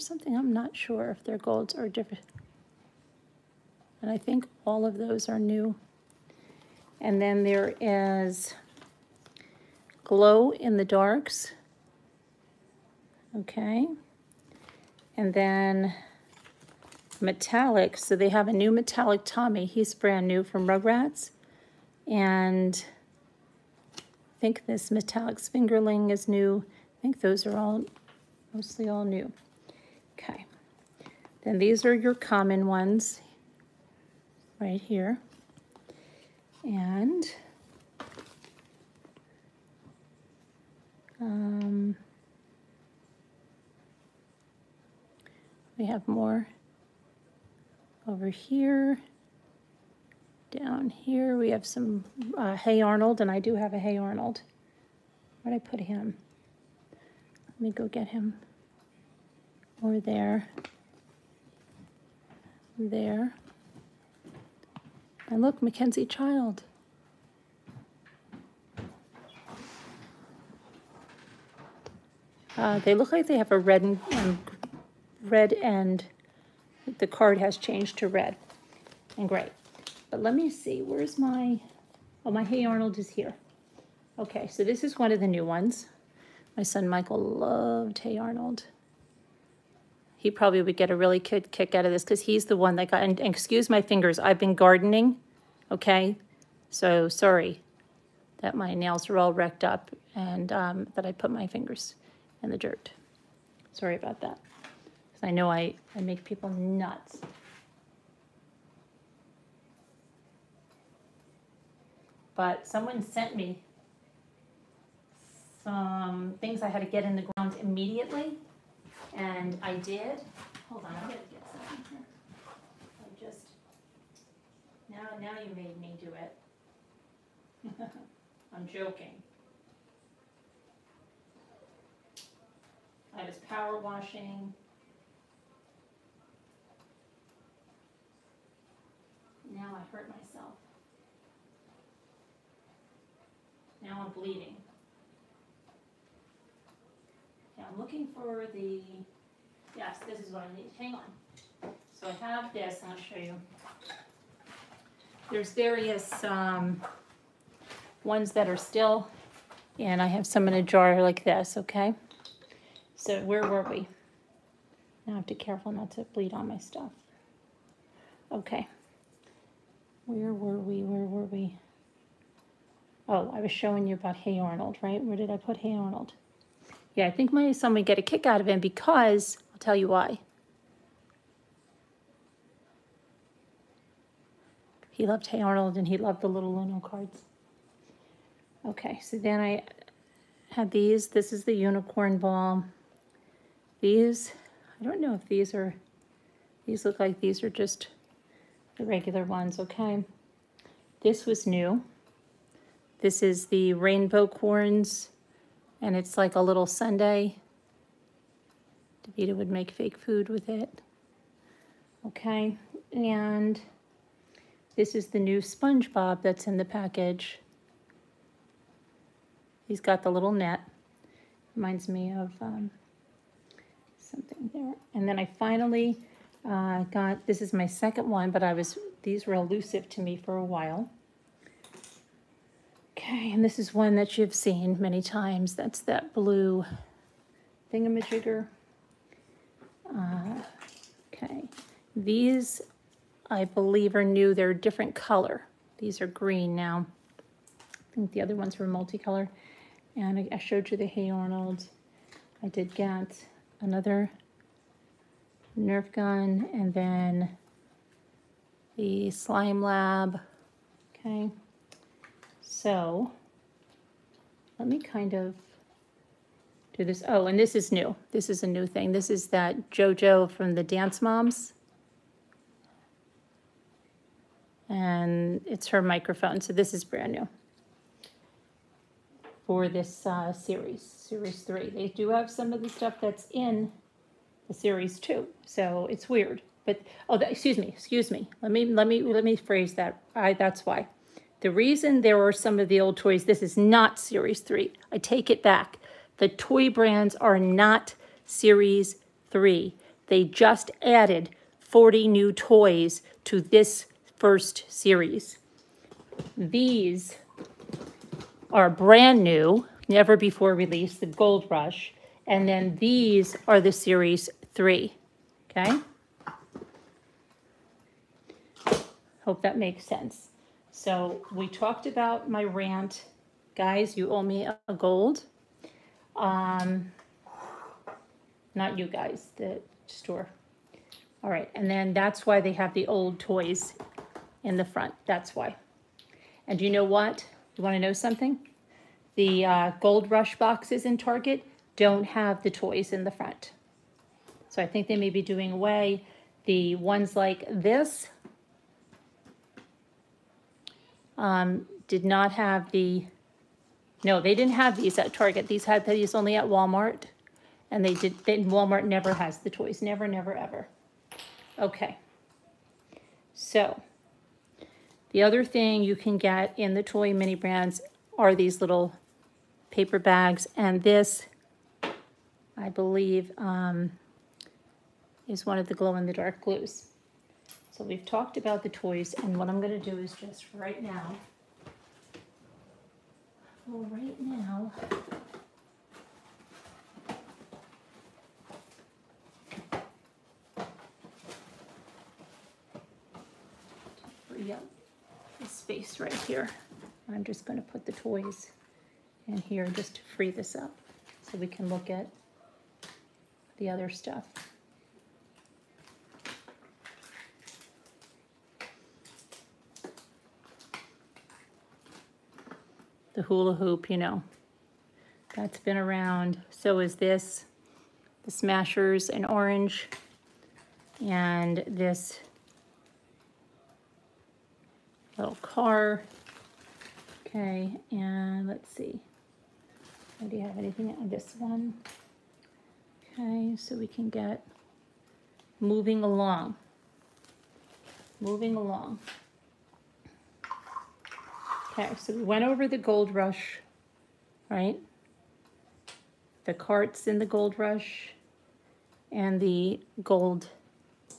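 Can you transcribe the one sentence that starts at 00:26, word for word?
I think those are all, mostly all new.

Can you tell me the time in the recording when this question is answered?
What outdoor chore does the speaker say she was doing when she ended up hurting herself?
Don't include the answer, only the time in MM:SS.
02:13.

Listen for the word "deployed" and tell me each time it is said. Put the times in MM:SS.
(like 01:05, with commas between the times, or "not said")
not said.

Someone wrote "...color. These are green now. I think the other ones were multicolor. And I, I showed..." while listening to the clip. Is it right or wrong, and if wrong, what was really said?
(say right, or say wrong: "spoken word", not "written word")
right.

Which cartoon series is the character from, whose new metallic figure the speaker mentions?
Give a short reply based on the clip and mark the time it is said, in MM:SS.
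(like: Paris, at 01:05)
Rugrats, at 00:20.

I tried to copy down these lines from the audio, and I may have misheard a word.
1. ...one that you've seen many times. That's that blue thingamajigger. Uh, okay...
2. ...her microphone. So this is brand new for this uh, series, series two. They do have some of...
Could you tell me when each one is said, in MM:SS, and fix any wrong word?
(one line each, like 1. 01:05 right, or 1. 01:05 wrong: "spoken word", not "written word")
1. 03:53 right
2. 04:35 wrong: "three", not "two".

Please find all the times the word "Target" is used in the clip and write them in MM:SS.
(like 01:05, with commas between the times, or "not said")
05:40, 05:55.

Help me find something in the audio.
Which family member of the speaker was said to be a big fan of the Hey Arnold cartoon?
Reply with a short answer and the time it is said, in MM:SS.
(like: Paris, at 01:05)
Michael, at 01:26.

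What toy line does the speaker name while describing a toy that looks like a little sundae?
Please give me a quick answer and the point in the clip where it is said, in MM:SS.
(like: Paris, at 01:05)
Rainbow corns, at 03:23.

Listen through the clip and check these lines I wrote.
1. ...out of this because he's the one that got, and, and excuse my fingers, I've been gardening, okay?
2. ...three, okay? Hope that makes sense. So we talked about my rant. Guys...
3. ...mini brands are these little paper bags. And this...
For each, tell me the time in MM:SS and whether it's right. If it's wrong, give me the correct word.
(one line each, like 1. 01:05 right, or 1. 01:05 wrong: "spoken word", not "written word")
1. 01:31 right
2. 05:14 right
3. 06:07 right.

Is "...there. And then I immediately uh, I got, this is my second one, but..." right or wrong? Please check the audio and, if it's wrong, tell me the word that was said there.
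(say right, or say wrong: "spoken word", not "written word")
wrong: "finally", not "immediately".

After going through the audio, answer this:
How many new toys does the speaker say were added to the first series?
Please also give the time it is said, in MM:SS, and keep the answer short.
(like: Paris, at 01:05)
40, at 05:01.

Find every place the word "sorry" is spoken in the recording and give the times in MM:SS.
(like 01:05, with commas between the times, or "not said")
01:37, 01:43.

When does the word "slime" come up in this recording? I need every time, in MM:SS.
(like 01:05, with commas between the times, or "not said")
04:19.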